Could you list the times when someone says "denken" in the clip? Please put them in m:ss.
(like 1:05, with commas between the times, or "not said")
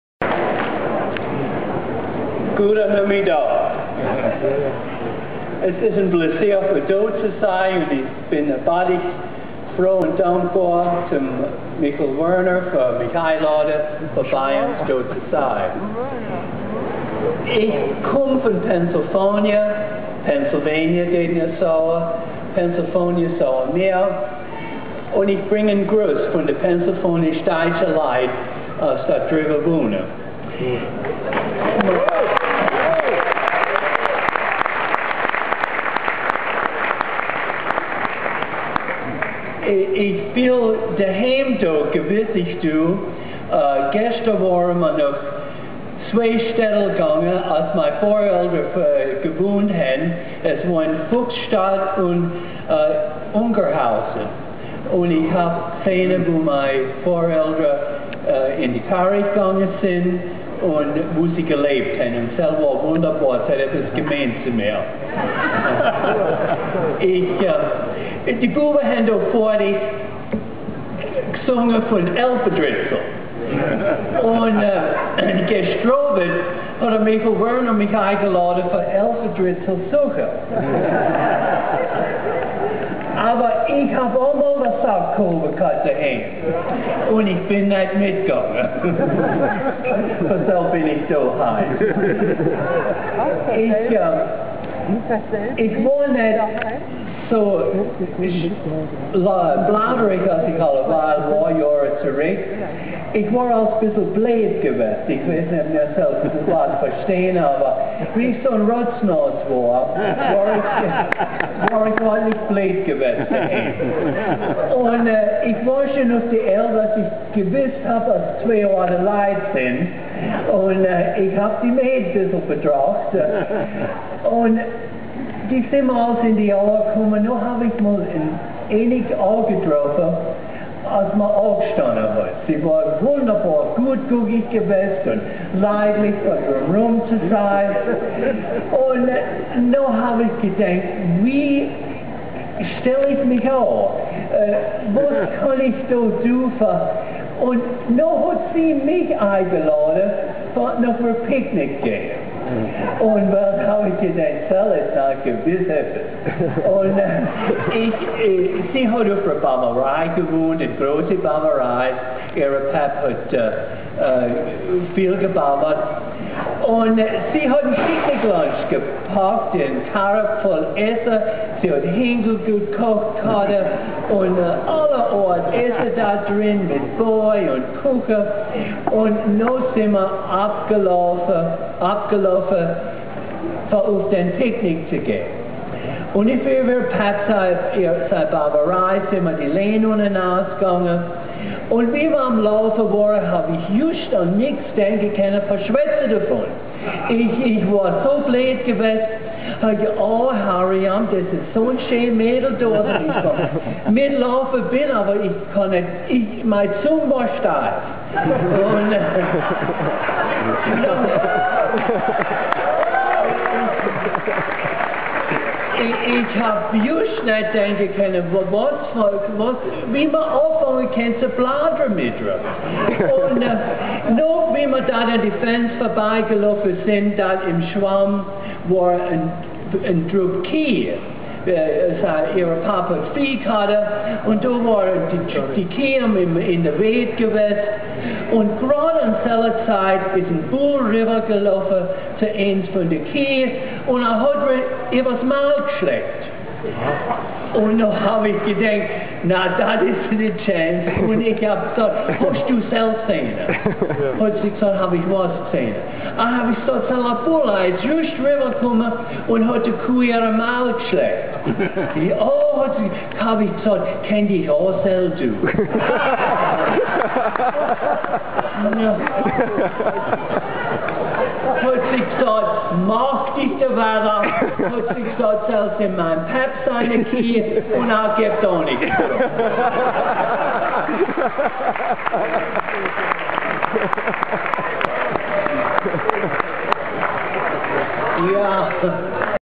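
3:14, 3:37.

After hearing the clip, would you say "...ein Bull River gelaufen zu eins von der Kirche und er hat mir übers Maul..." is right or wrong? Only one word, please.
right.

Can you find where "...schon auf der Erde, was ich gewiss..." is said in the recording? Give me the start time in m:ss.
1:55.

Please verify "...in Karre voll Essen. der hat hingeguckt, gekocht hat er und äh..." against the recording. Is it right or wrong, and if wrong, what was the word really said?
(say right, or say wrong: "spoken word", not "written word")
right.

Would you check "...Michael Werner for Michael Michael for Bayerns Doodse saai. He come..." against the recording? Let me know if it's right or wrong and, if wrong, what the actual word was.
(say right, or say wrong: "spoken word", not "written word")
wrong: "Lade", not "Michael".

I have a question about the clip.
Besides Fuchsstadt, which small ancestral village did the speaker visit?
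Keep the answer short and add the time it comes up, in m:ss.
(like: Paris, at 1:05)
Ungerhausen, at 0:53.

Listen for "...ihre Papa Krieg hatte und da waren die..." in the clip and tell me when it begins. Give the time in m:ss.
3:52.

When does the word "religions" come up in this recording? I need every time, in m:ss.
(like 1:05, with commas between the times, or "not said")
not said.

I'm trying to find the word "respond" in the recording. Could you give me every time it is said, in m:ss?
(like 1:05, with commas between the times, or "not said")
not said.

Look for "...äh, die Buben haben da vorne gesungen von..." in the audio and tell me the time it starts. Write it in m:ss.
1:08.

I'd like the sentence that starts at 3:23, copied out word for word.
Mit laufen bin, aber ich kann nicht, ich, mein Zung war stark.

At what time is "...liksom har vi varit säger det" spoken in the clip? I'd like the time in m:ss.
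4:14.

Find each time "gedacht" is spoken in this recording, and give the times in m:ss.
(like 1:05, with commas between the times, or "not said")
2:20, 4:08.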